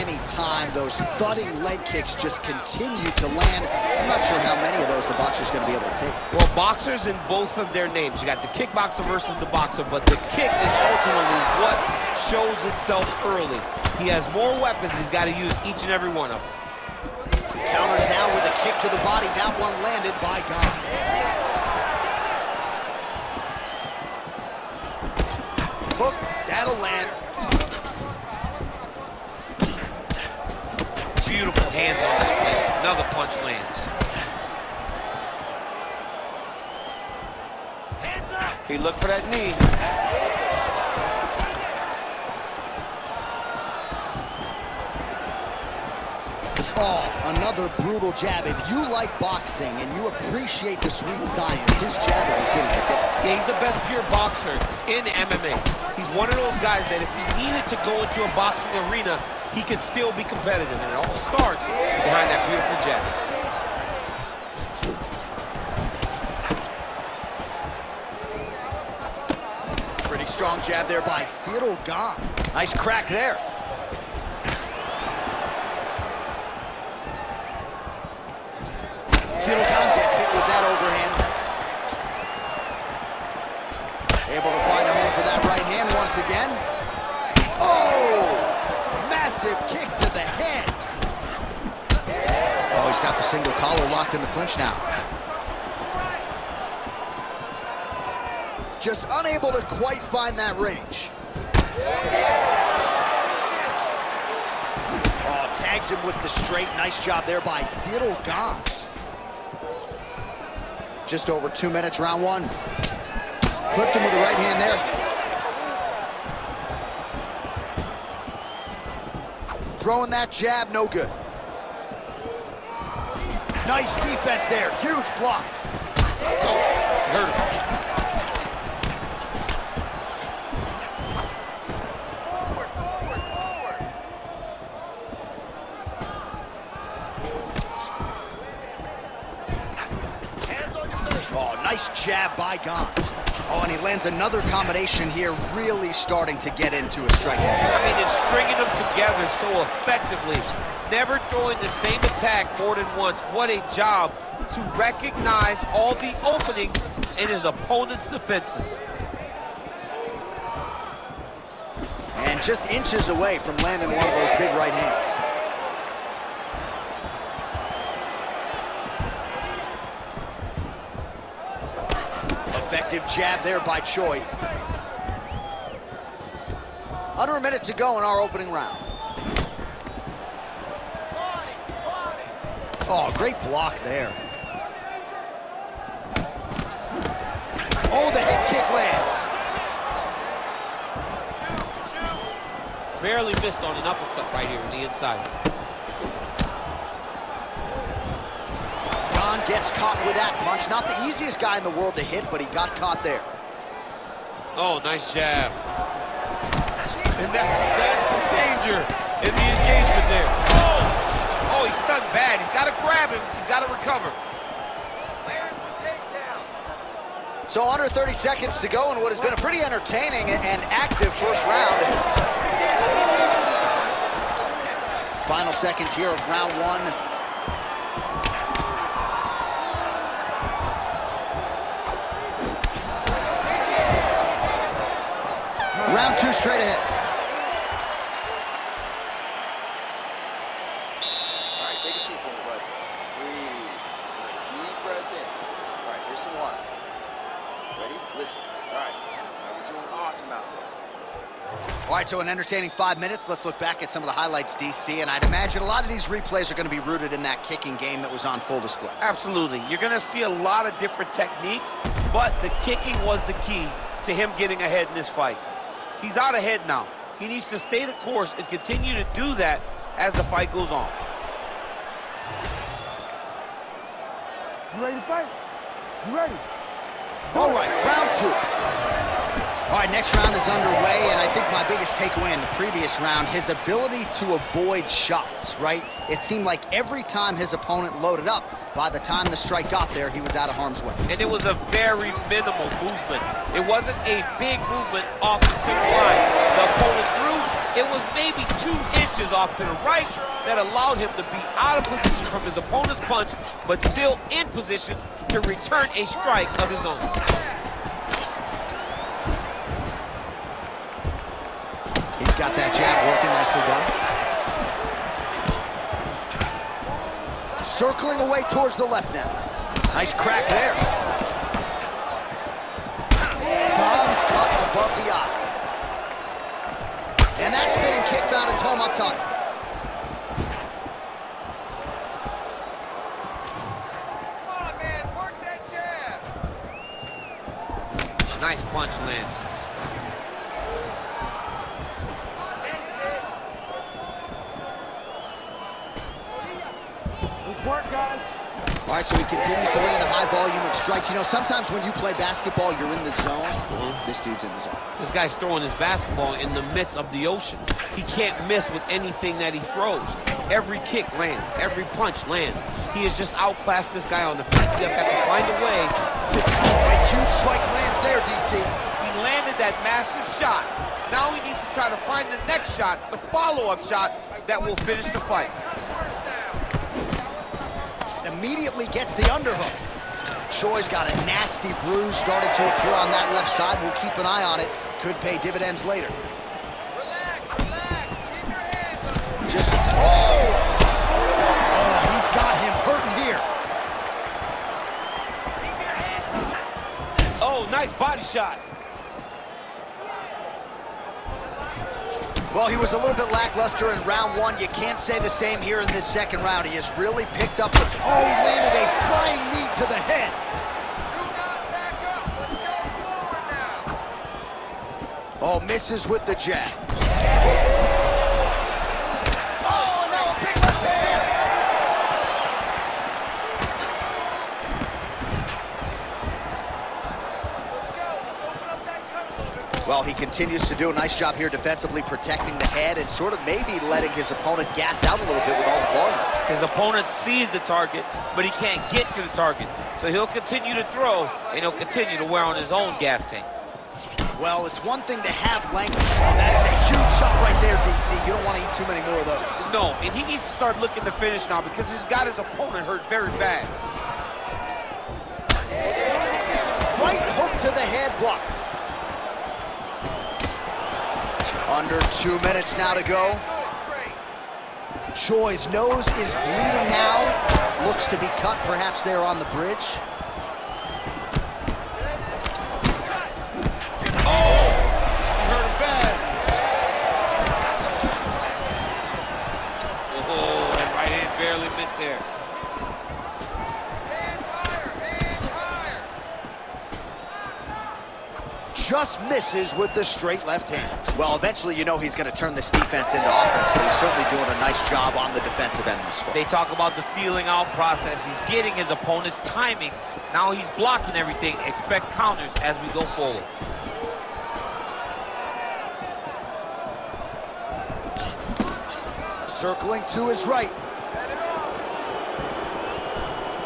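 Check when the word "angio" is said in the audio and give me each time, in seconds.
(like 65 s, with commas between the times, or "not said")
not said.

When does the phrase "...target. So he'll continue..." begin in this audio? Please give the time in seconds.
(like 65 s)
439 s.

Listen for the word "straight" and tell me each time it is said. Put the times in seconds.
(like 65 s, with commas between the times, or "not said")
106 s, 236 s, 490 s.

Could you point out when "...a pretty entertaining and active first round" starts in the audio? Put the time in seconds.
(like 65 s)
219 s.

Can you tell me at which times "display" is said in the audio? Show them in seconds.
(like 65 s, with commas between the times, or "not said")
258 s.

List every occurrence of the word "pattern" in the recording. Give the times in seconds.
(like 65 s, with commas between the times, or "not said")
not said.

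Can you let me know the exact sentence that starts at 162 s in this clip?
And just inches away from landing one of those big right hands.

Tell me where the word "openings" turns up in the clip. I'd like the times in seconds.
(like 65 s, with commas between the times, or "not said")
156 s, 178 s.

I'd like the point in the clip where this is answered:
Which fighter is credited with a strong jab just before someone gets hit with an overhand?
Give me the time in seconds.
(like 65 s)
70 s.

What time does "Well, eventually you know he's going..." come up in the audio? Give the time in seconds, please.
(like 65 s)
491 s.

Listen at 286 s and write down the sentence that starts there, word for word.
It seemed like every time his opponent loaded up, by the time the strike got there, he was out of harm's way.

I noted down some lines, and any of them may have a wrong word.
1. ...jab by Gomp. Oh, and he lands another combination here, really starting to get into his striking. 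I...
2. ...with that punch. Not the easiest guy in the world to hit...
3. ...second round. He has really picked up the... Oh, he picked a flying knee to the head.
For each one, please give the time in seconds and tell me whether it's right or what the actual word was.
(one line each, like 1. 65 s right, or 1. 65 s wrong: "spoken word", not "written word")
1. 142 s right
2. 200 s right
3. 406 s wrong: "landed", not "picked".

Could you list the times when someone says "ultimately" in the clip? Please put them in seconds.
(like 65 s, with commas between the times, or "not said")
10 s.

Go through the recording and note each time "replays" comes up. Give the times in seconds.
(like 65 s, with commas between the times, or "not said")
256 s.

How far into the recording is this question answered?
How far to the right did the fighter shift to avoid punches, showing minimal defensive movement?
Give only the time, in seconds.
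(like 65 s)
298 s.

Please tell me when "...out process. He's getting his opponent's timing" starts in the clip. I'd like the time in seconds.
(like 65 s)
497 s.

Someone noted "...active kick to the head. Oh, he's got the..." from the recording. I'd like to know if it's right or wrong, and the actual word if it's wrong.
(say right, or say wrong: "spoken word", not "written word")
wrong: "massive", not "active".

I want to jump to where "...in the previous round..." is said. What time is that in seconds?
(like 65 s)
282 s.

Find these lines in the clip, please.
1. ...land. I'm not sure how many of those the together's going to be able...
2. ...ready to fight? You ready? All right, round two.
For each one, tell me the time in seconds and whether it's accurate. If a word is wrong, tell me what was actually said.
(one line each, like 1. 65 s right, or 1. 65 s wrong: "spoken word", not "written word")
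1. 3 s wrong: "boxer", not "together"
2. 274 s right.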